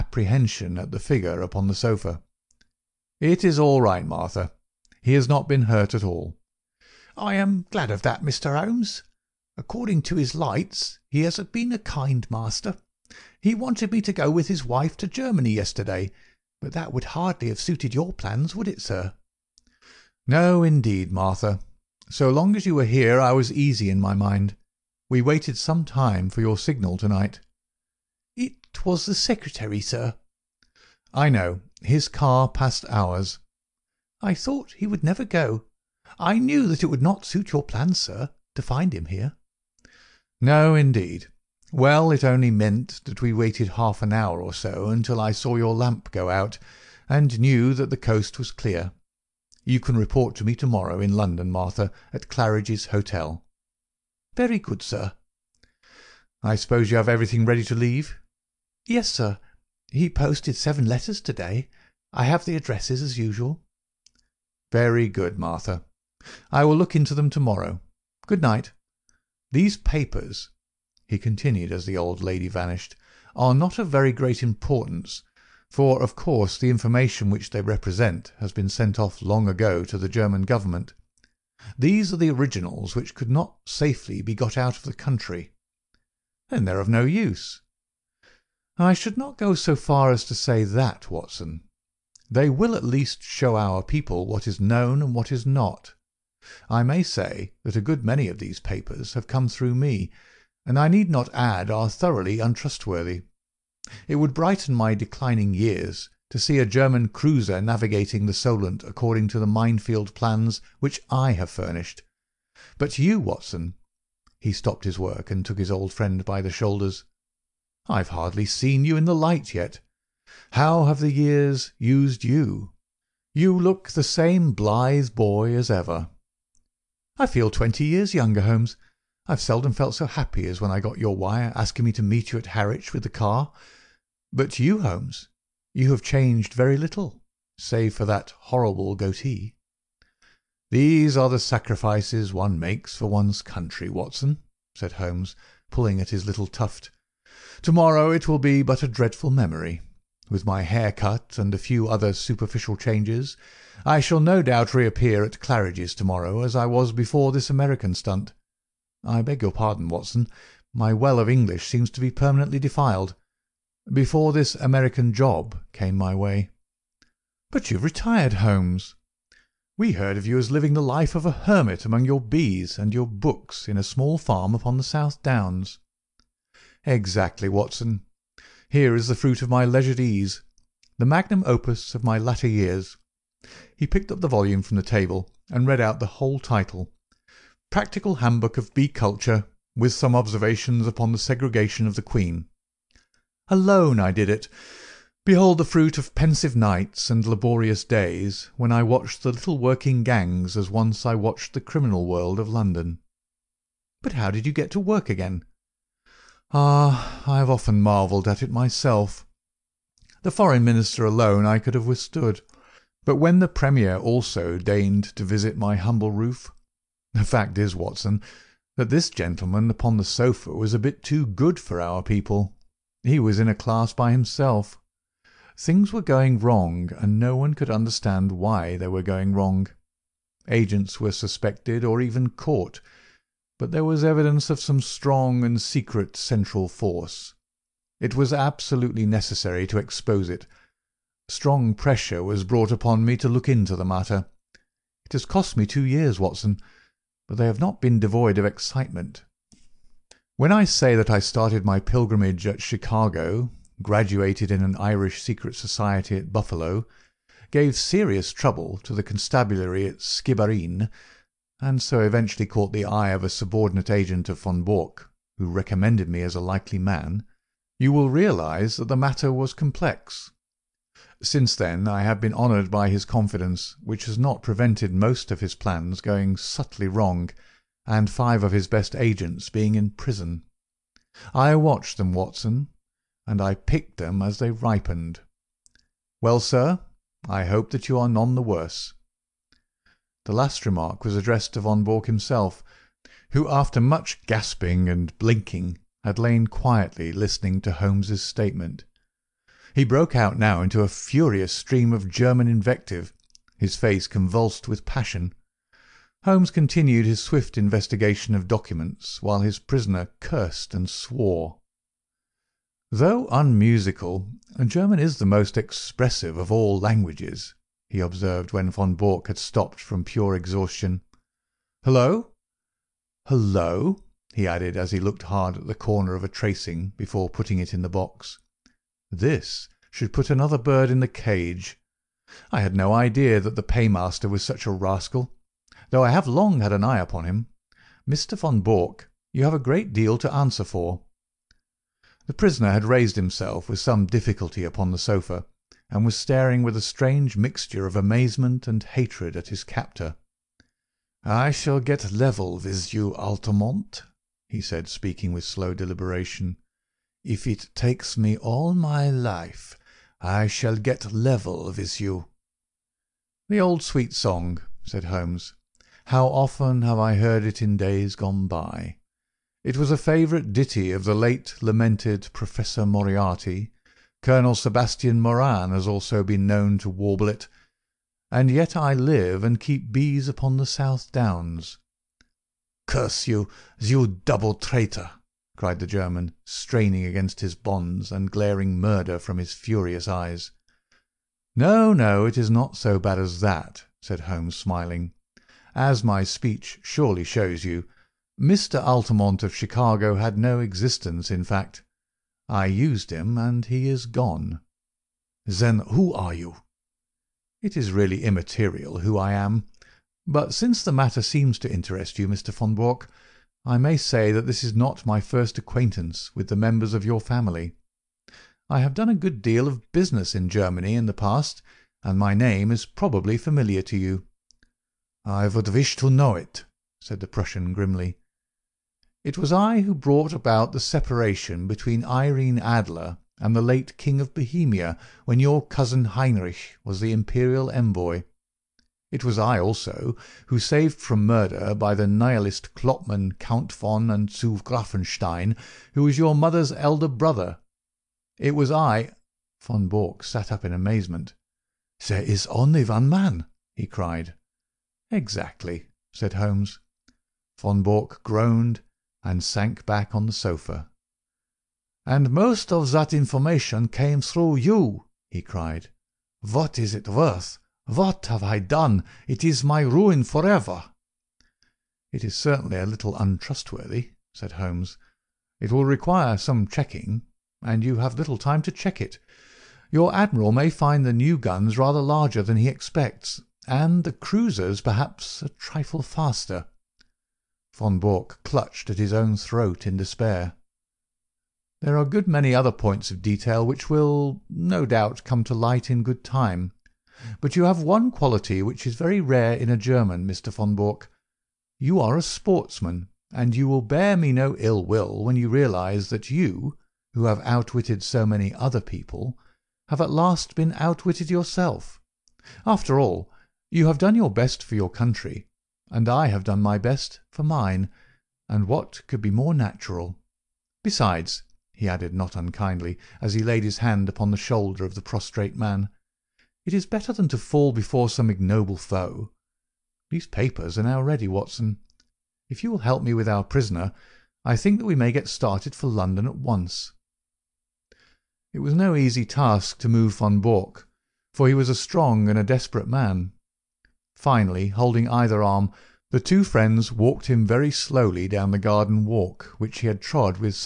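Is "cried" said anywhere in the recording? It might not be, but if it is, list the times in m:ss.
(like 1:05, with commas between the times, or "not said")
6:25, 7:33, 7:45.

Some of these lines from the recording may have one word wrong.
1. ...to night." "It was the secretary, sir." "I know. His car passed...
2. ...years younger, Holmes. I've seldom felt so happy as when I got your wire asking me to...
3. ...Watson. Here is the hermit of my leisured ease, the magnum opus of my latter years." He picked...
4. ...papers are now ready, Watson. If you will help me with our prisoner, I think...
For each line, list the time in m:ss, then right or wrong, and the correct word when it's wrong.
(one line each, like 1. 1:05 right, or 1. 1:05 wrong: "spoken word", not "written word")
1. 0:26 right
2. 2:07 right
3. 2:57 wrong: "fruit", not "hermit"
4. 8:50 right.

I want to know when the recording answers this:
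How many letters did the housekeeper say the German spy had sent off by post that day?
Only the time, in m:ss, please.
1:00.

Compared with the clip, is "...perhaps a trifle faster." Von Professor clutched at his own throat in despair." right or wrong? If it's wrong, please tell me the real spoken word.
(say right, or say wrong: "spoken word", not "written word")
wrong: "Bork", not "Professor".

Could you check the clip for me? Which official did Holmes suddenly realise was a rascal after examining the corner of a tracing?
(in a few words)
the paymaster.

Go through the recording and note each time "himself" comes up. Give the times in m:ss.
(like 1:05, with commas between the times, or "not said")
3:44, 4:52, 5:43.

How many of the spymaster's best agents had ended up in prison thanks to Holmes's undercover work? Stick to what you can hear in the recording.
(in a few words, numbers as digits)
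5.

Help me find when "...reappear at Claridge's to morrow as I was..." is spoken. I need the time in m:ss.
2:34.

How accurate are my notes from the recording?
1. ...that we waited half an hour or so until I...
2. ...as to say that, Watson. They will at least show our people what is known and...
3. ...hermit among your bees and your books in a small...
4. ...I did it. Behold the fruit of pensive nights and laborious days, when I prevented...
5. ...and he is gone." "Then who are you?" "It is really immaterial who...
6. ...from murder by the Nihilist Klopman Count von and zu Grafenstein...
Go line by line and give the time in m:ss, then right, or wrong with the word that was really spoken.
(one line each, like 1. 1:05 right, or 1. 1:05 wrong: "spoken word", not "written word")
1. 0:43 right
2. 1:30 right
3. 2:51 right
4. 3:13 wrong: "watched", not "prevented"
5. 6:43 right
6. 7:20 right.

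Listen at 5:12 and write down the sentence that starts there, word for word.
"Though unmusical, German is the most expressive of all languages," he observed when Von Bork had stopped from pure exhaustion.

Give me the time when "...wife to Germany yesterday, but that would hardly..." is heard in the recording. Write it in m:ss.
0:14.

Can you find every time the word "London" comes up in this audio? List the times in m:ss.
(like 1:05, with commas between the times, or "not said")
0:51, 3:22, 8:55.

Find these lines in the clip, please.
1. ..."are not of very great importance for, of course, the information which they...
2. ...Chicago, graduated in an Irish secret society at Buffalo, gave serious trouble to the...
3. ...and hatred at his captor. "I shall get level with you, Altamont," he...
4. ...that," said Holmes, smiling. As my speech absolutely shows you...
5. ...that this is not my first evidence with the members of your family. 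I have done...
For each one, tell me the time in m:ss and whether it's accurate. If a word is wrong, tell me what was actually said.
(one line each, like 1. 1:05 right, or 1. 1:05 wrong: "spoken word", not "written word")
1. 1:13 right
2. 4:12 right
3. 5:48 right
4. 6:33 wrong: "surely", not "absolutely"
5. 6:54 wrong: "acquaintance", not "evidence".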